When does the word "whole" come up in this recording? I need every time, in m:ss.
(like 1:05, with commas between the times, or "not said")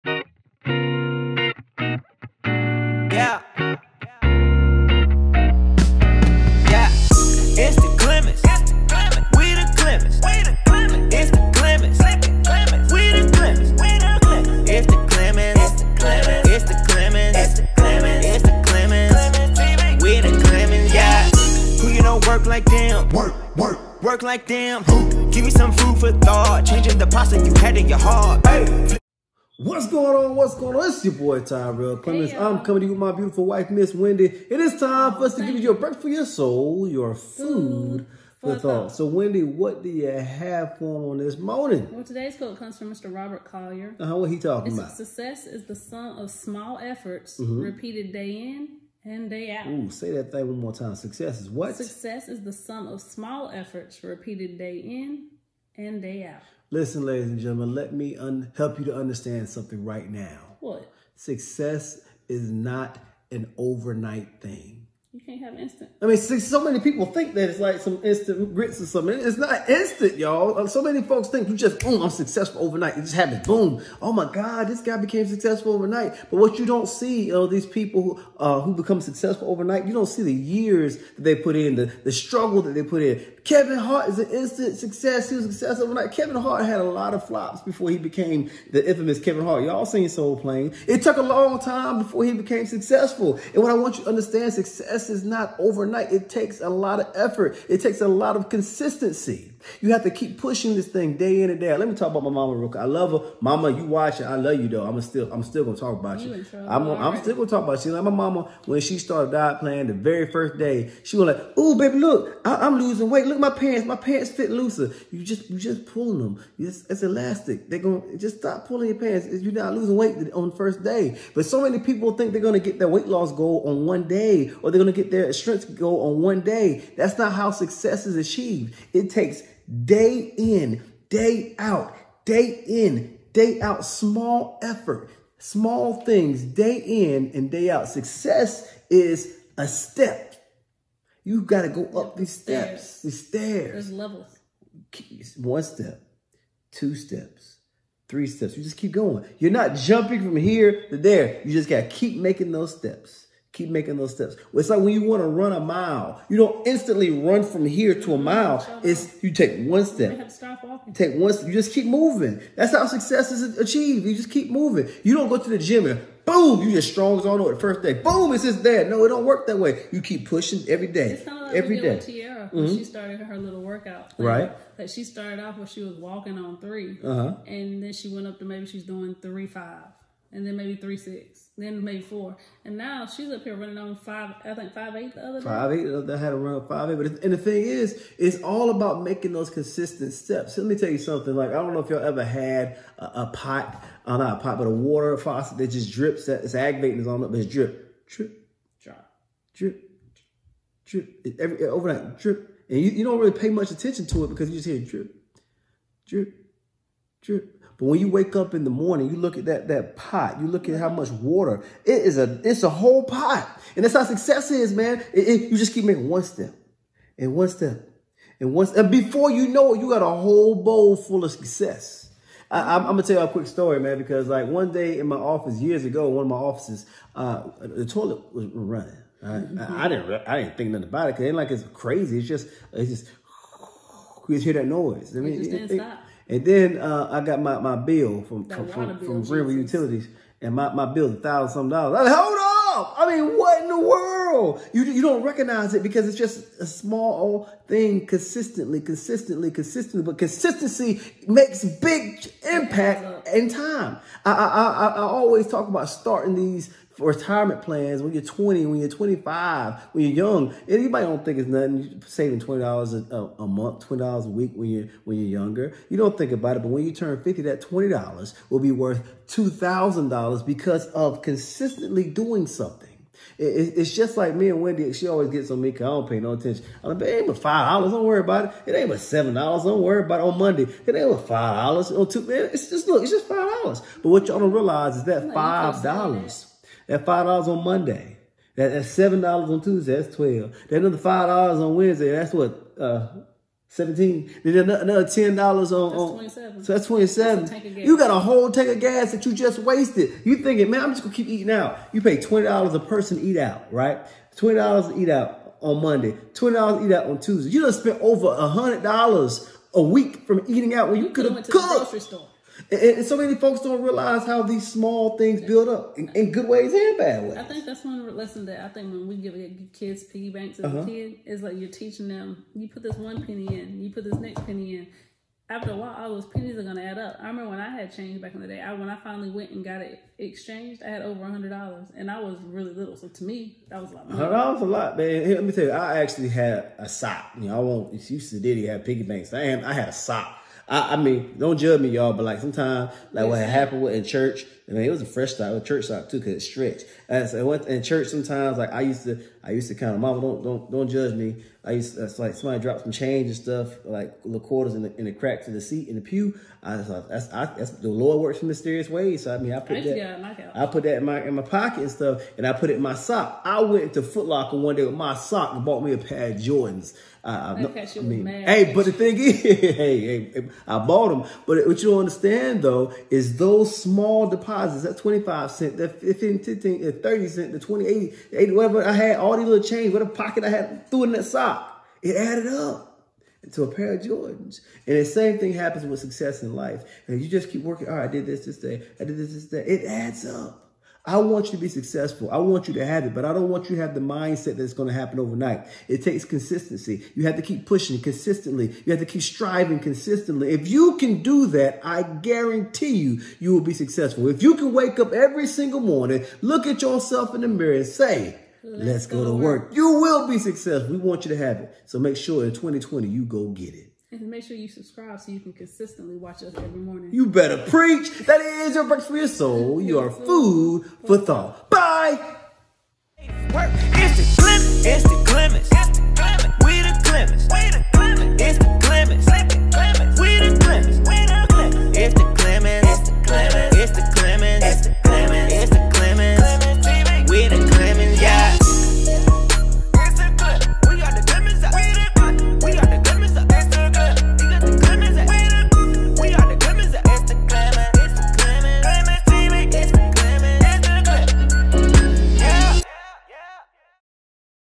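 3:32, 3:40, 4:58.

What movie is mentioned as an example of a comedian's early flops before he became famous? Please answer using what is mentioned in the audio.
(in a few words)
Soul Plane.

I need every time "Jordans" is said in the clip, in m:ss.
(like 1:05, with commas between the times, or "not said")
6:06, 6:24.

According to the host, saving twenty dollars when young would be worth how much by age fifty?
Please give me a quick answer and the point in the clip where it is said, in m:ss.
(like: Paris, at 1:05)
$2,000, at 4:29.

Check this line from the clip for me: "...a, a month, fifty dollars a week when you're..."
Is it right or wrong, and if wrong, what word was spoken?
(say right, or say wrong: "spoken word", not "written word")
wrong: "twenty", not "fifty".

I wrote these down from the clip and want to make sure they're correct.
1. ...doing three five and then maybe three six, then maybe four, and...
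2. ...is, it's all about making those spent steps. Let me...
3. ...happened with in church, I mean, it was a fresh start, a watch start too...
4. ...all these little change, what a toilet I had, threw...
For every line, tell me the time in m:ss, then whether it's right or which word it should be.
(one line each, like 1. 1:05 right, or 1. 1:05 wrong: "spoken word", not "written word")
1. 2:58 right
2. 3:07 wrong: "consistent", not "spent"
3. 5:43 wrong: "church", not "watch"
4. 6:19 wrong: "pocket", not "toilet".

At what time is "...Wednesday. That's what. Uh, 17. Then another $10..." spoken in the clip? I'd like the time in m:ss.
4:51.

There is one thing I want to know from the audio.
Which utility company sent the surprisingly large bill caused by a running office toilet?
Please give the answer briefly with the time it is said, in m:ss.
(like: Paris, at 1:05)
River Utilities, at 3:59.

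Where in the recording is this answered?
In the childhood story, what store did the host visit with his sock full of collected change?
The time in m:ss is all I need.
6:04.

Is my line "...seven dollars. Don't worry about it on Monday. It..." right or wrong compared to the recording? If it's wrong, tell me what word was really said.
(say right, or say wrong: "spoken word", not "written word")
right.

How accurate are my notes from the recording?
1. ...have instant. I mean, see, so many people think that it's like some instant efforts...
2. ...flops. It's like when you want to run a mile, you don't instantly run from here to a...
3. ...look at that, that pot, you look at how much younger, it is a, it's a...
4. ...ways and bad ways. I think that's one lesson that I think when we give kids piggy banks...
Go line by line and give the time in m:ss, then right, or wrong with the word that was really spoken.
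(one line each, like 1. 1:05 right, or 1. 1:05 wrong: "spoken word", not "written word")
1. 1:05 wrong: "grits", not "efforts"
2. 2:34 wrong: "steps", not "flops"
3. 3:29 wrong: "water", not "younger"
4. 5:16 right.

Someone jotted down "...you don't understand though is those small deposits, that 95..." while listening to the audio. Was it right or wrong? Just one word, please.
wrong.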